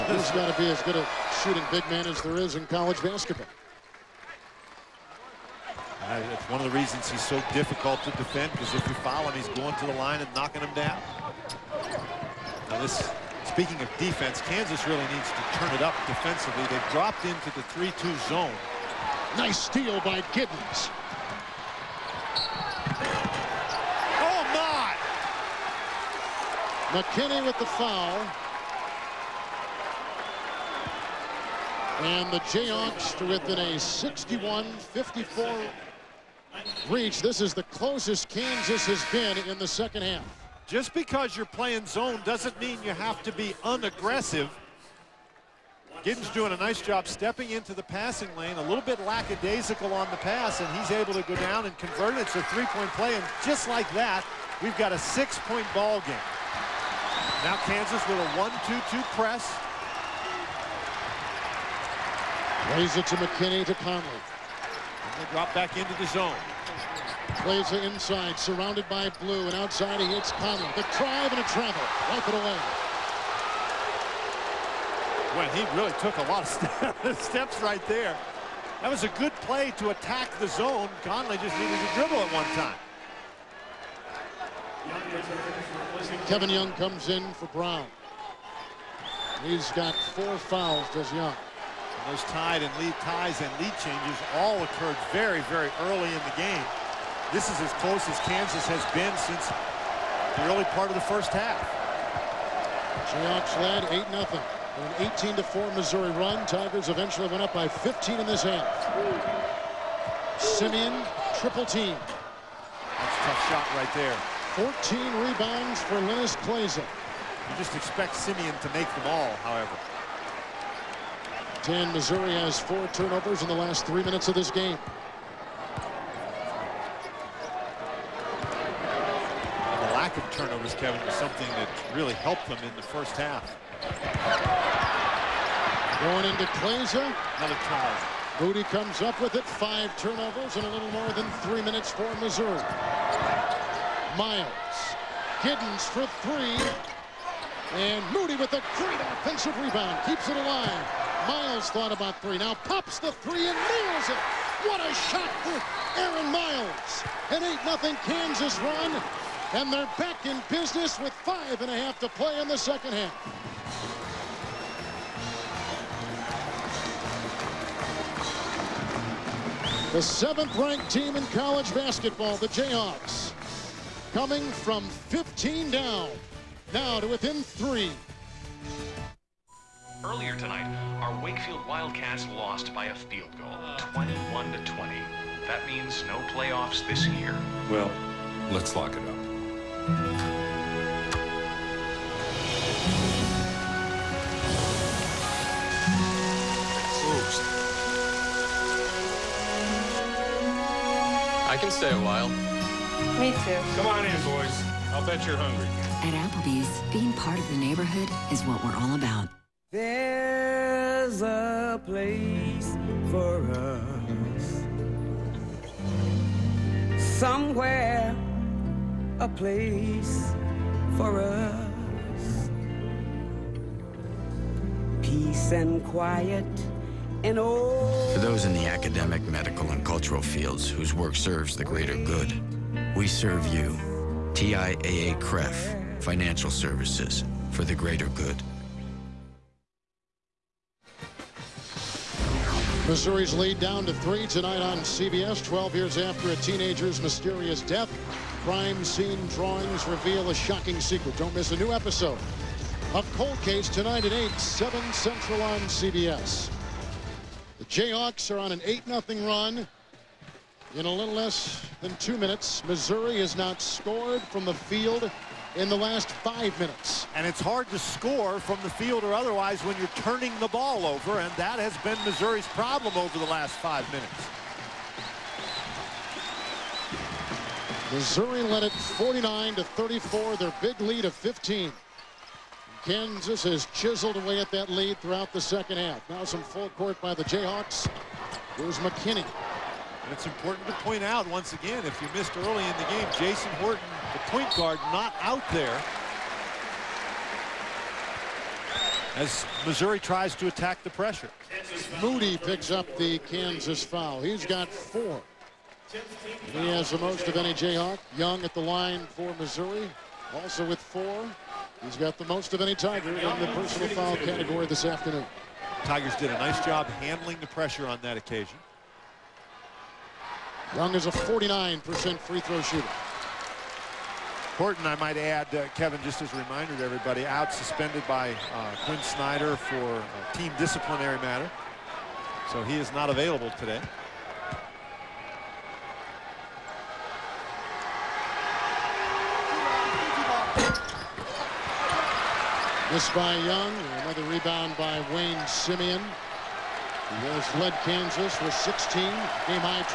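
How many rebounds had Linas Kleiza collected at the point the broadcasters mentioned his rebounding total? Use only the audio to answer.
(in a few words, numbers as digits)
14.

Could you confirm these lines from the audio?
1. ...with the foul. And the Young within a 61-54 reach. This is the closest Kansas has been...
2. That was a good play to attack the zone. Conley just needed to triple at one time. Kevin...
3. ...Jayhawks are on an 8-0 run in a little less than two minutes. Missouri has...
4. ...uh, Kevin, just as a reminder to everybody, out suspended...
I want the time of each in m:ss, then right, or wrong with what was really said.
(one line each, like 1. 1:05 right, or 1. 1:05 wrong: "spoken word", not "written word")
1. 0:27 wrong: "Jayhawks", not "Young"
2. 1:18 wrong: "dribble", not "triple"
3. 4:17 right
4. 5:25 right.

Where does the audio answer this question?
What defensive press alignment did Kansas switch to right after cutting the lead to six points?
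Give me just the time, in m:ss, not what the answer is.
0:58.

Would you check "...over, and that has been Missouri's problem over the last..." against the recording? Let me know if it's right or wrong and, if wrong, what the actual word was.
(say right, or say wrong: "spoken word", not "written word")
right.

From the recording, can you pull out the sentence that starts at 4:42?
Kansas has chiseled away at that lead throughout the second half.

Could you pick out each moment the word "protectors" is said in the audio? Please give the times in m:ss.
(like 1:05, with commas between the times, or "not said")
not said.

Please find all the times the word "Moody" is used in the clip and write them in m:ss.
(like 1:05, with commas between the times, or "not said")
2:18, 2:28, 5:02.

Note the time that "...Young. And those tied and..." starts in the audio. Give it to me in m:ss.
1:31.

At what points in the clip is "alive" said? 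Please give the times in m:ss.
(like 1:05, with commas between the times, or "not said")
2:30.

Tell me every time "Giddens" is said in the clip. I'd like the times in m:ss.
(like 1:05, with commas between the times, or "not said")
0:20, 0:46, 2:25.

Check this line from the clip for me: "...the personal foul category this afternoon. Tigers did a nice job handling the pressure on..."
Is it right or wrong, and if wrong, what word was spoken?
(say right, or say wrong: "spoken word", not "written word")
right.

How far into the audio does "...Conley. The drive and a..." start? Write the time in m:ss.
1:10.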